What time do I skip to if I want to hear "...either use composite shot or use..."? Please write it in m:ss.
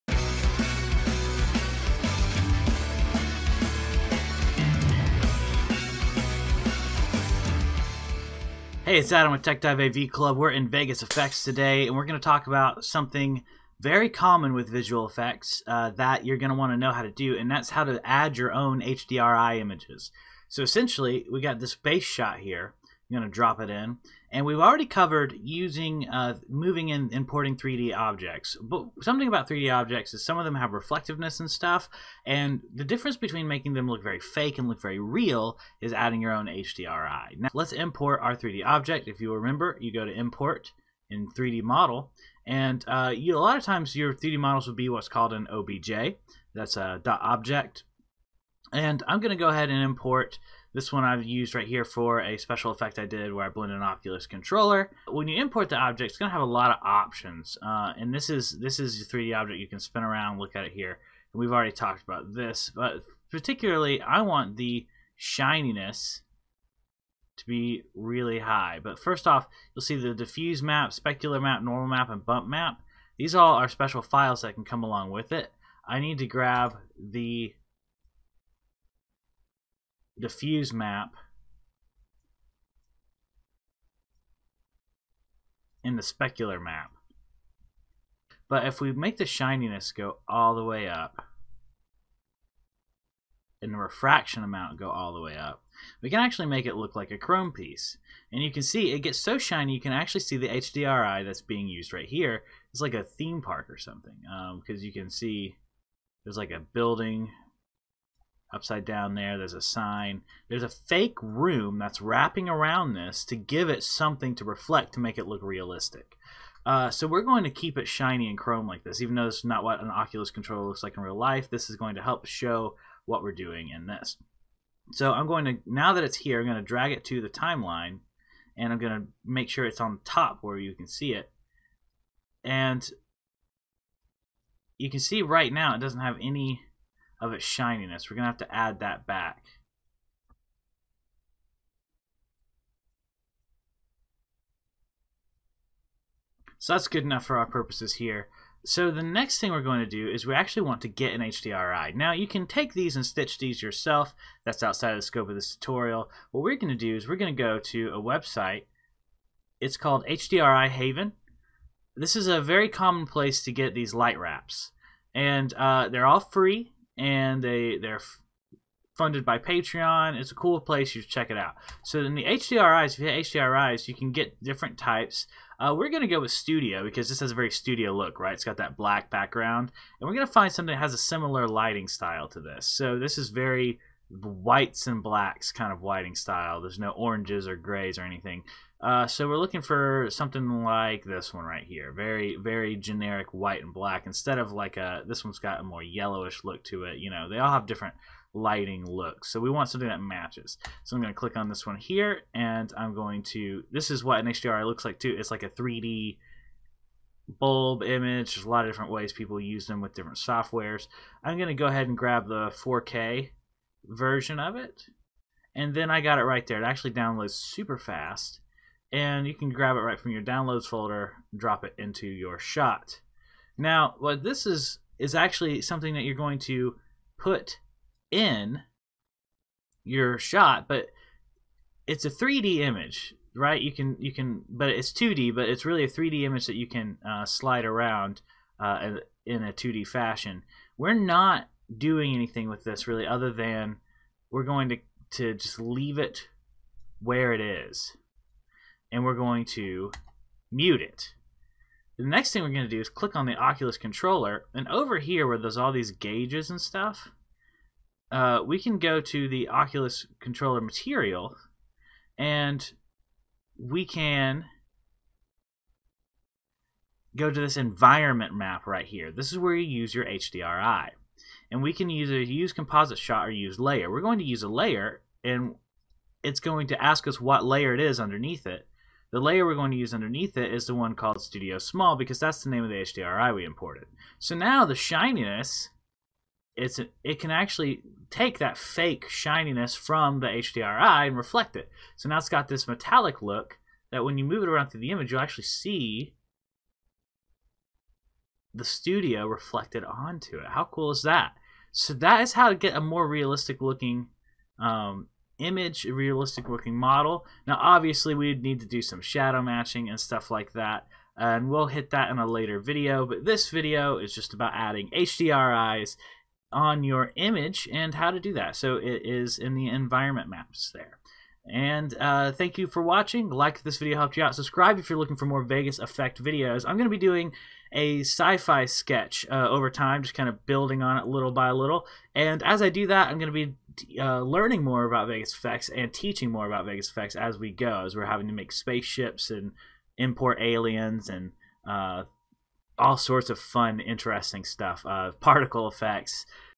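4:31.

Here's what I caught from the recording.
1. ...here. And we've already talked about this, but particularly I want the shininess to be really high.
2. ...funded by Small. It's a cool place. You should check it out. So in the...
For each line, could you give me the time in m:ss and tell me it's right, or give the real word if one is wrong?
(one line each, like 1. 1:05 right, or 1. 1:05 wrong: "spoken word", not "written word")
1. 1:00 right
2. 2:48 wrong: "Patreon", not "Small".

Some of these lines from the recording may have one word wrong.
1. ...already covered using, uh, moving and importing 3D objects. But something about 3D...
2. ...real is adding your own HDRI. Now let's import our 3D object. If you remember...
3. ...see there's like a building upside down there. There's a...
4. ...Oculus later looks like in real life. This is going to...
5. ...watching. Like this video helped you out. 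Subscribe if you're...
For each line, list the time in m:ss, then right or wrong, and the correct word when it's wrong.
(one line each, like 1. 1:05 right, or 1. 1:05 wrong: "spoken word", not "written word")
1. 0:24 right
2. 0:34 right
3. 1:45 right
4. 1:59 wrong: "controller", not "later"
5. 5:22 right.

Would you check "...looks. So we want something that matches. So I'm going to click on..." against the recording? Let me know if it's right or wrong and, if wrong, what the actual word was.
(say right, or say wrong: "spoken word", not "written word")
right.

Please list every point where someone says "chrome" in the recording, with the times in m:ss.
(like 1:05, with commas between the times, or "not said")
1:37, 1:58.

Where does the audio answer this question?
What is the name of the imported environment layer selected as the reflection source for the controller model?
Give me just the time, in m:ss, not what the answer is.
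4:41.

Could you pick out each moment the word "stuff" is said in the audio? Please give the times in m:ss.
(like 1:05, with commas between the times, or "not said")
0:31, 4:16, 5:09, 5:44.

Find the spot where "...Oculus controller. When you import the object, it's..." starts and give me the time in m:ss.
0:53.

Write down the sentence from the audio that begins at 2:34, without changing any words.
That's outside of the scope of this tutorial.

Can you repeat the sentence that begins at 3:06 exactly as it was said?
There's no oranges or grays or anything.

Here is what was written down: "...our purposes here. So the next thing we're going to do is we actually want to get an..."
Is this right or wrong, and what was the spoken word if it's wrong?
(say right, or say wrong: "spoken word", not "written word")
right.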